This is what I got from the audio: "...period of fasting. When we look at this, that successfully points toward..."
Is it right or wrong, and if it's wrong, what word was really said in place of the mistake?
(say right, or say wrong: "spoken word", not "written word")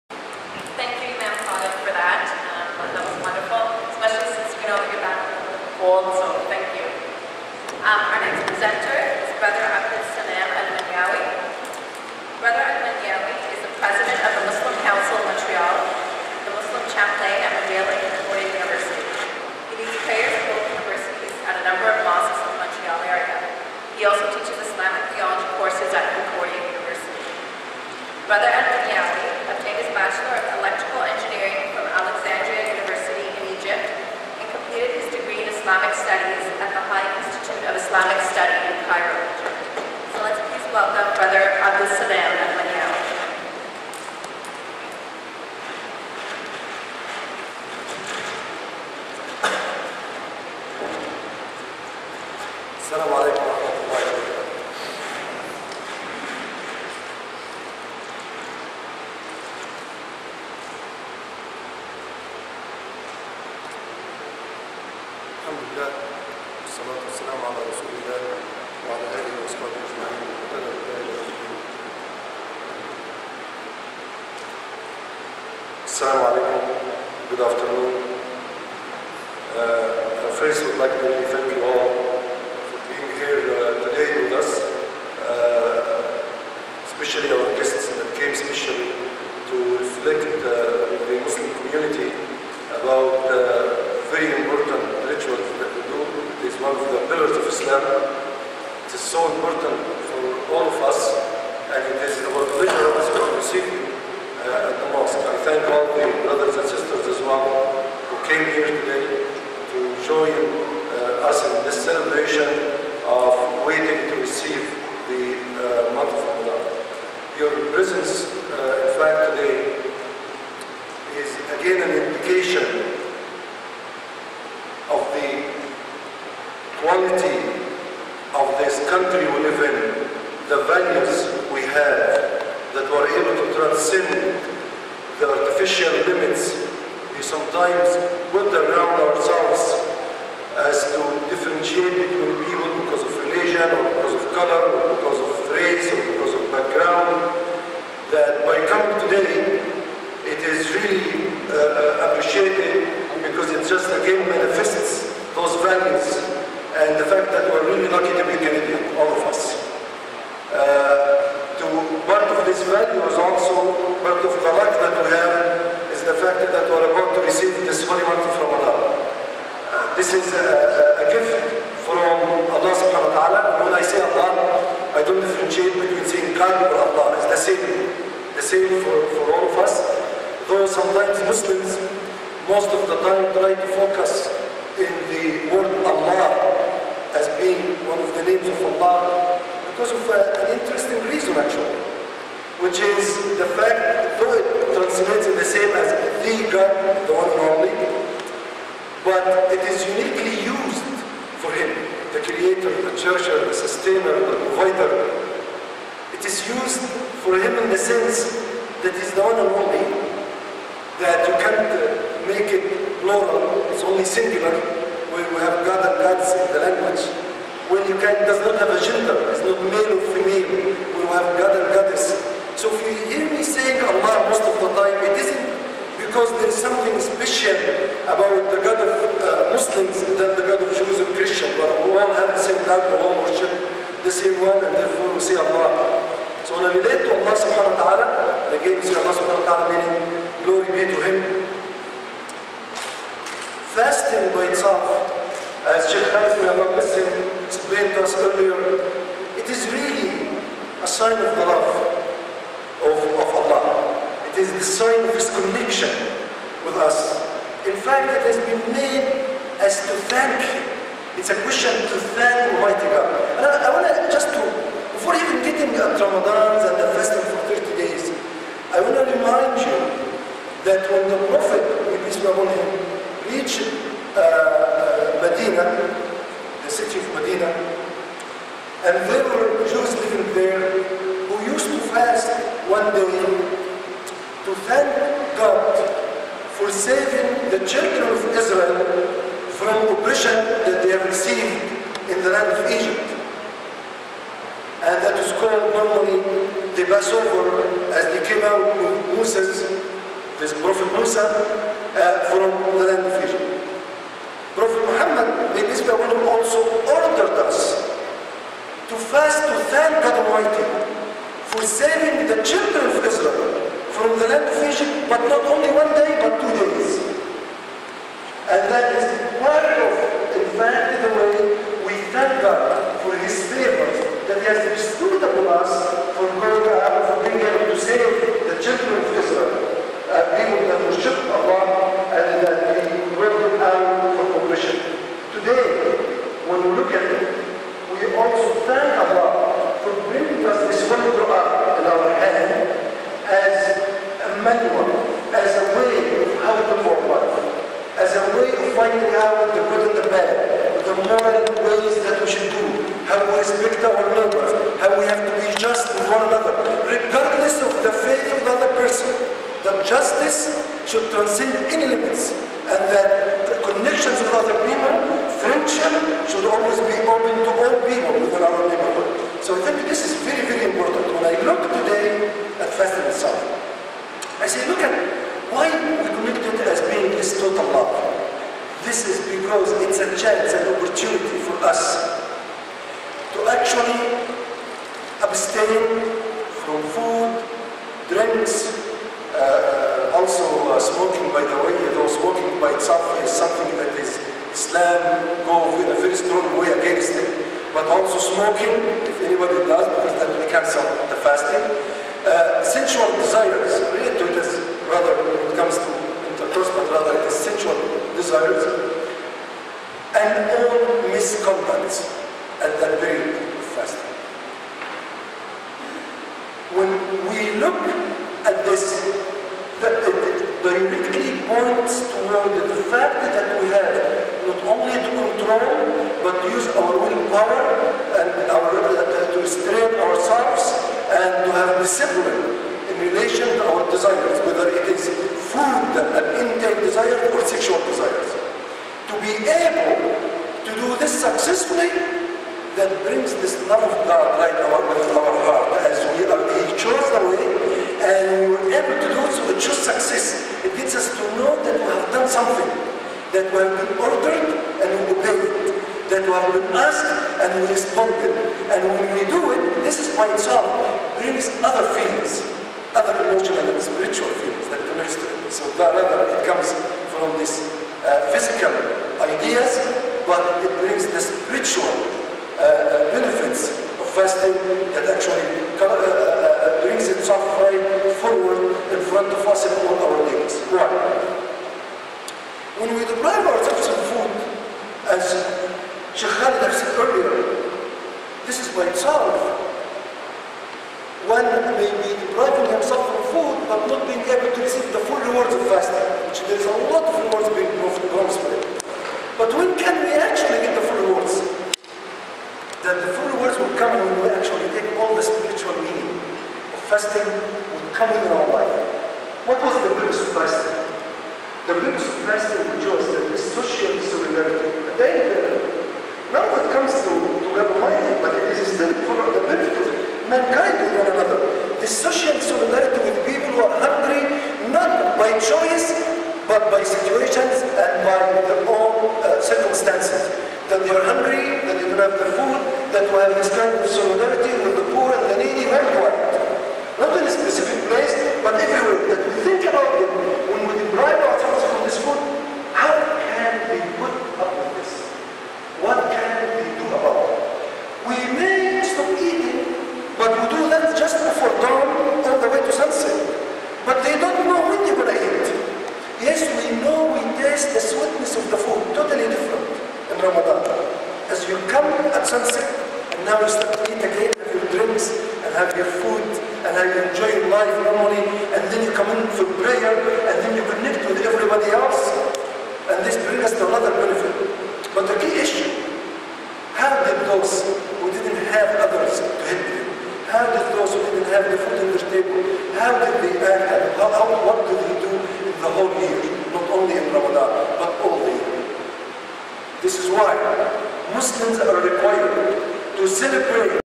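wrong: "directly", not "successfully".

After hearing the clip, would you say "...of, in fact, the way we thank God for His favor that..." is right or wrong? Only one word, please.
right.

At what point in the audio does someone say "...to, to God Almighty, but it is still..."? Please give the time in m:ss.
8:36.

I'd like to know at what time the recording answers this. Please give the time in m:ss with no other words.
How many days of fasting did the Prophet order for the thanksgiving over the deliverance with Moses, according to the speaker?
5:16.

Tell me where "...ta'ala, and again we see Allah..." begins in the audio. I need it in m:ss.
3:57.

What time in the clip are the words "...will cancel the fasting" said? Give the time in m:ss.
6:40.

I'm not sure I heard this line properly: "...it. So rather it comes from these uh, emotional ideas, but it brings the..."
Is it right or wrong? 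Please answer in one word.
wrong.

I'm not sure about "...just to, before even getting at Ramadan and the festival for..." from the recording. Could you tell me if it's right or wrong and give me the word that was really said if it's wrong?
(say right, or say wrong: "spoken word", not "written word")
right.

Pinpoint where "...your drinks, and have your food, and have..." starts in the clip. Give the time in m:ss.
9:24.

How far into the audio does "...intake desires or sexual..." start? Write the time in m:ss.
7:16.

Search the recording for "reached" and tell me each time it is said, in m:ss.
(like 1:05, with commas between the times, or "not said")
4:33.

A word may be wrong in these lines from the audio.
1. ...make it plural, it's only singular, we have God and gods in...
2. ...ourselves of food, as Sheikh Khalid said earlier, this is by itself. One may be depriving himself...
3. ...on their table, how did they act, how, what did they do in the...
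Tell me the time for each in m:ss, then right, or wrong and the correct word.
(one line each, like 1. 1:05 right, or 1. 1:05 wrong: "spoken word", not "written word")
1. 3:32 right
2. 8:03 right
3. 9:41 right.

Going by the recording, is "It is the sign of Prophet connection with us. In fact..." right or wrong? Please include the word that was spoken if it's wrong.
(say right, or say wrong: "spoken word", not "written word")
wrong: "His", not "Prophet".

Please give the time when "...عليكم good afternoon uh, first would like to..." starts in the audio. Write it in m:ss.
1:16.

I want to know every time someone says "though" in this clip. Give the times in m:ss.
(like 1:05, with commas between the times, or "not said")
3:00, 3:14.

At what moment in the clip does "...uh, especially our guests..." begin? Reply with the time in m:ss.
1:25.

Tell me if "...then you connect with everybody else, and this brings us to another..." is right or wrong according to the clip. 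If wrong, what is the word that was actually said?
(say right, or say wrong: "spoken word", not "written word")
right.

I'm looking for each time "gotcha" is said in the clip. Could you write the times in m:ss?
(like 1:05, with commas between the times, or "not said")
not said.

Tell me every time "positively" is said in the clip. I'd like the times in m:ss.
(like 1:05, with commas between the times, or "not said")
not said.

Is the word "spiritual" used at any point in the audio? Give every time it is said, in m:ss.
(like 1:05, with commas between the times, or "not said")
7:43, 7:51, 8:25.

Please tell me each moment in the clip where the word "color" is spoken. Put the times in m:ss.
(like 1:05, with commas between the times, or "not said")
2:24.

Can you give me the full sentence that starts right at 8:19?
But when can we actually get the full rewards?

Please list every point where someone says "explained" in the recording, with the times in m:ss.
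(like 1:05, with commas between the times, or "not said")
4:07.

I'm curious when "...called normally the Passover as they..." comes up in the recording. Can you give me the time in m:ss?
4:55.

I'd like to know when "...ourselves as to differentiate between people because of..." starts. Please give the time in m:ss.
2:19.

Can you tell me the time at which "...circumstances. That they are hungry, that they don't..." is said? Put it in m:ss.
8:49.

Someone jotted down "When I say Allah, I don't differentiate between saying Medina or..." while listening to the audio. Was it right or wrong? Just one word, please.
wrong.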